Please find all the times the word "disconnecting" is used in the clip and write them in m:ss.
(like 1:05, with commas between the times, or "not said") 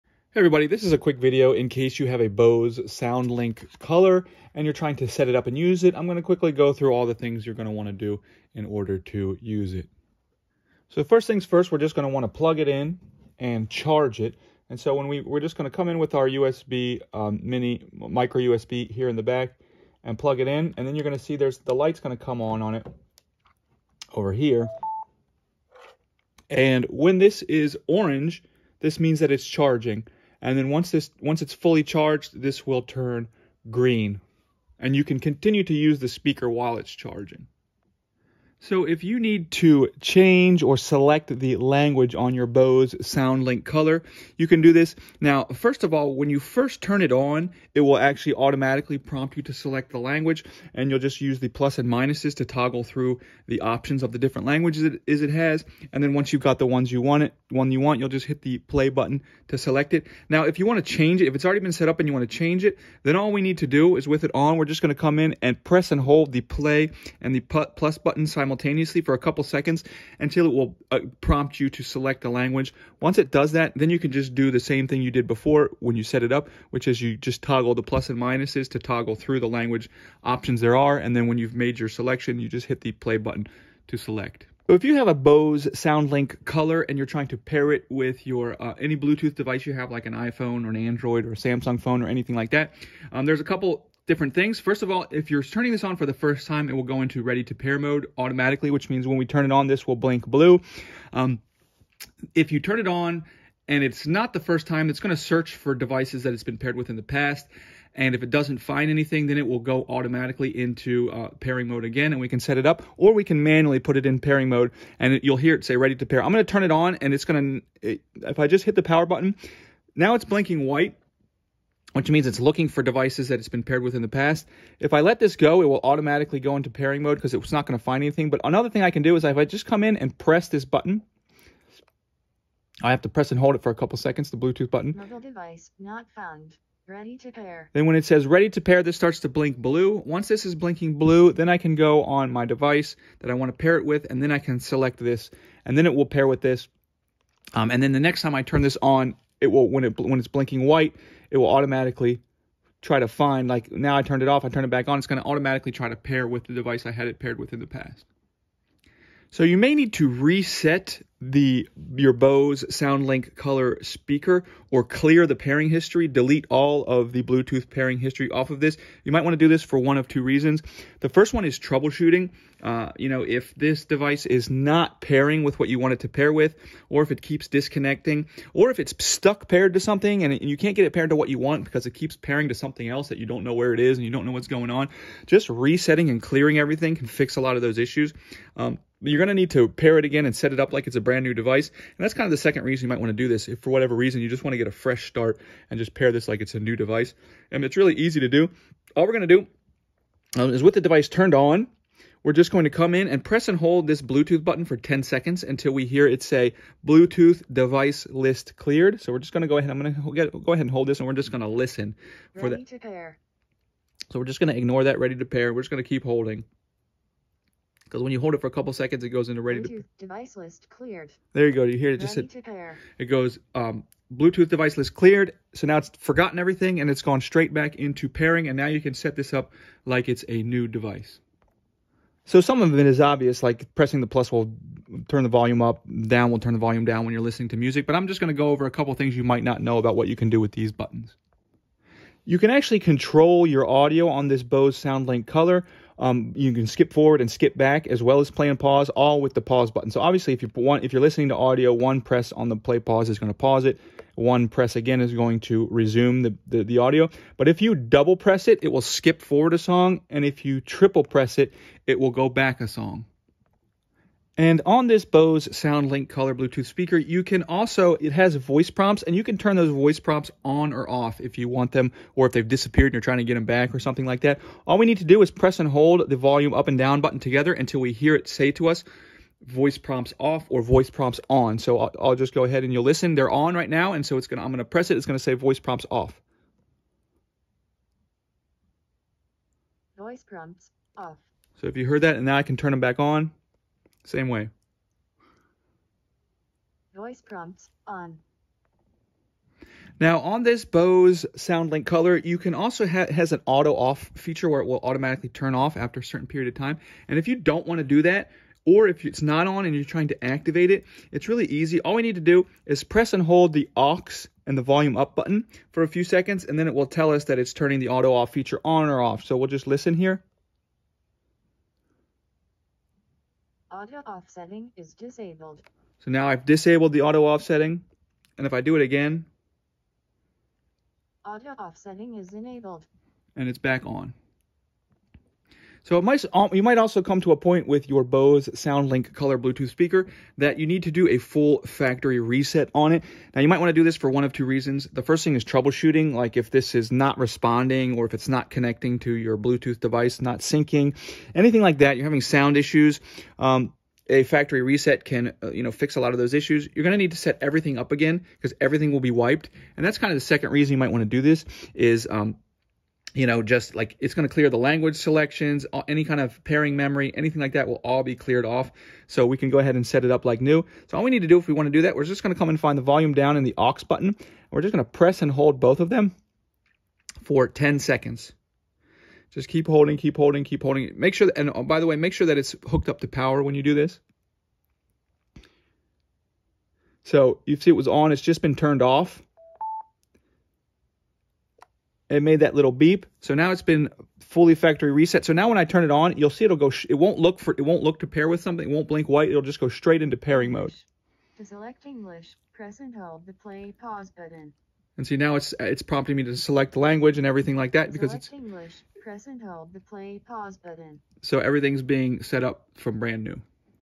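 2:57.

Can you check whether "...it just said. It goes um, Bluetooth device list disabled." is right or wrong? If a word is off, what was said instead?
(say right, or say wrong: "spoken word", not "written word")
wrong: "cleared", not "disabled".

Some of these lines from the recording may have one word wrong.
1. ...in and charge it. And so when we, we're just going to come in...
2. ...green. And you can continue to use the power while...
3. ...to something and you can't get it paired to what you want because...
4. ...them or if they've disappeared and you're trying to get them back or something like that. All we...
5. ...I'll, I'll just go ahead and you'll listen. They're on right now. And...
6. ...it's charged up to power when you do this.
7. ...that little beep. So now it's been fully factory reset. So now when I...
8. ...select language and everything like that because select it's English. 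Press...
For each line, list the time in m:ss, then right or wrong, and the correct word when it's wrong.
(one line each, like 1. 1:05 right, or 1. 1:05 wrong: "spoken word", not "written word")
1. 0:12 right
2. 0:33 wrong: "speaker", not "power"
3. 2:59 right
4. 4:31 right
5. 4:41 right
6. 6:22 wrong: "hooked", not "charged"
7. 6:32 right
8. 6:46 right.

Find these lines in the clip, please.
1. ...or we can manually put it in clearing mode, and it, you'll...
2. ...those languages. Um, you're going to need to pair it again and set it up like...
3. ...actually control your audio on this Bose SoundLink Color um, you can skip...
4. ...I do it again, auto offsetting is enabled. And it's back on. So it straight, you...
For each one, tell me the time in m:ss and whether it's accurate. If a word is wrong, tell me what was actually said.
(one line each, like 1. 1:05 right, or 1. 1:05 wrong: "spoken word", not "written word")
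1. 1:52 wrong: "pairing", not "clearing"
2. 3:07 wrong: "issues", not "languages"
3. 4:02 right
4. 5:28 wrong: "might", not "straight".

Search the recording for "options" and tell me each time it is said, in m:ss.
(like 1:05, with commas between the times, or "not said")
0:53, 1:20.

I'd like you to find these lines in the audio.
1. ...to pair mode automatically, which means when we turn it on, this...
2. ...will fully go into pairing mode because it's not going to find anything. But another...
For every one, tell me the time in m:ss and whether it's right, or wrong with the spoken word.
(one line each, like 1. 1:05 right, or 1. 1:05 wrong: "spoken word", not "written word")
1. 1:37 right
2. 2:05 wrong: "automatically", not "fully".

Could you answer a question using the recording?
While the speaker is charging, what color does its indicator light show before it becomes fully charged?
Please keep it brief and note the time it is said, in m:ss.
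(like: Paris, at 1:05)
orange, at 0:27.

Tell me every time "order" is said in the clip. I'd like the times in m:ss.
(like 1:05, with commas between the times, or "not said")
0:08.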